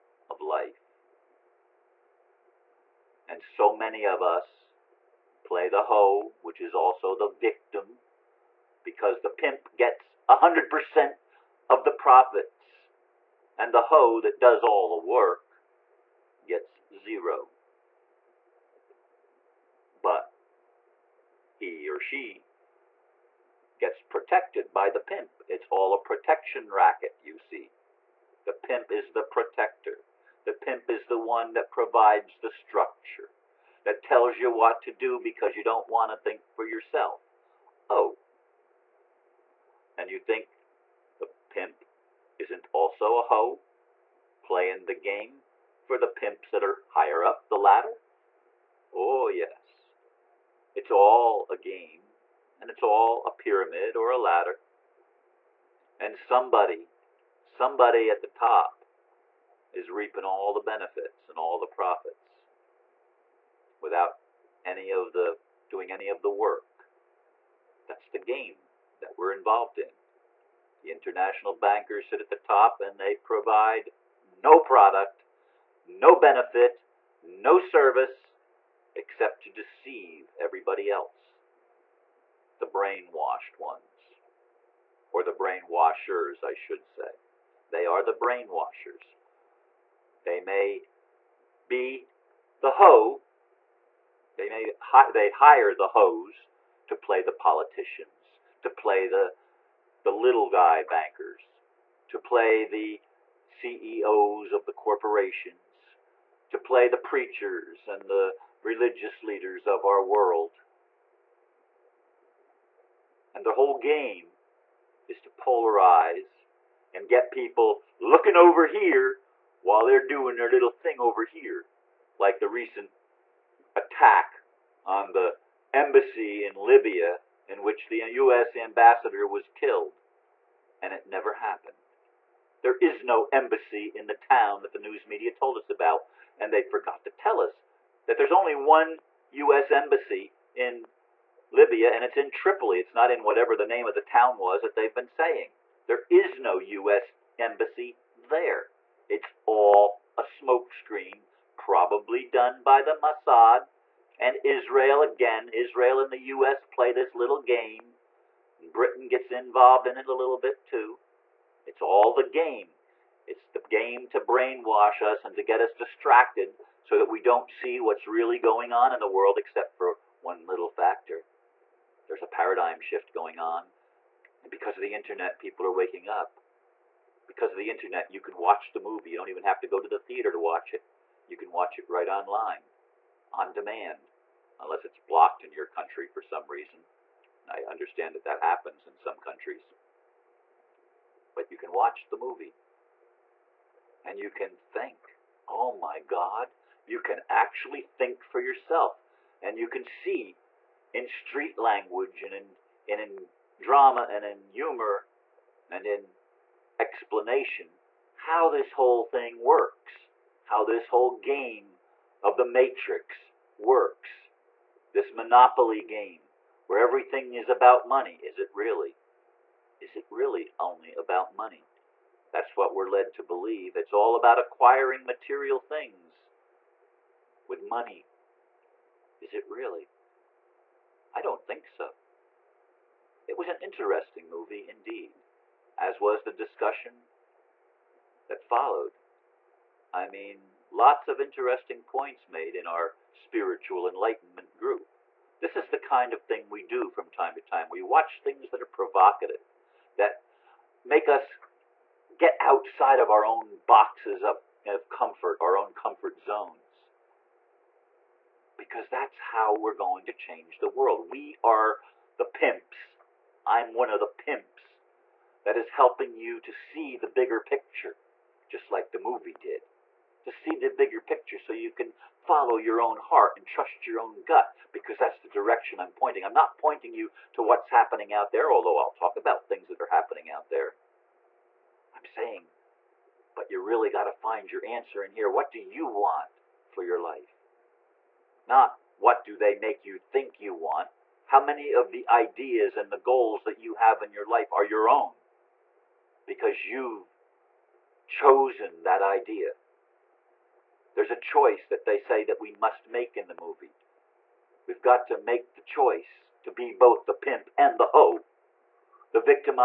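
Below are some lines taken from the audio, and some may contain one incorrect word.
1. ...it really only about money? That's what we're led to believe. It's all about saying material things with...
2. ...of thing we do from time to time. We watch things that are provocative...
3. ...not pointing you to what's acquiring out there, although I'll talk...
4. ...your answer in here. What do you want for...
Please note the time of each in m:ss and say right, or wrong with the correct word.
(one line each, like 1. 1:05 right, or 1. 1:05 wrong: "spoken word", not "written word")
1. 3:39 wrong: "acquiring", not "saying"
2. 4:06 right
3. 4:36 wrong: "happening", not "acquiring"
4. 4:44 right.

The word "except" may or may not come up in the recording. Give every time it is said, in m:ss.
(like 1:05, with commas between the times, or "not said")
1:18, 2:49.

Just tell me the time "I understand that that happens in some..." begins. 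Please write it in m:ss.
3:07.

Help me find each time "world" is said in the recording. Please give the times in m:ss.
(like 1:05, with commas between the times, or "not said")
1:50, 2:49, 4:20.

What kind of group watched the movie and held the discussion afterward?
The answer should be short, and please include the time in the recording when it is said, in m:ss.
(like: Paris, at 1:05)
Spiritual enlightenment group, at 4:03.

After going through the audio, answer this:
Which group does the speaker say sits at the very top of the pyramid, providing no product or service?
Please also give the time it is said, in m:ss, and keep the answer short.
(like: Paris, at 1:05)
The international bankers, at 1:10.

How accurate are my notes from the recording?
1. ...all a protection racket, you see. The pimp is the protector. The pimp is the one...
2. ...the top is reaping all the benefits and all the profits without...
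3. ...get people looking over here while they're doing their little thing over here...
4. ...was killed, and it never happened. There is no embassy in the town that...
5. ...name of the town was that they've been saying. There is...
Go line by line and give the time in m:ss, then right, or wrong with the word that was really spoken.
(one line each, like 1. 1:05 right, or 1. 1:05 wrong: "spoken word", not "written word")
1. 0:25 right
2. 0:58 right
3. 1:57 right
4. 2:09 right
5. 2:23 right.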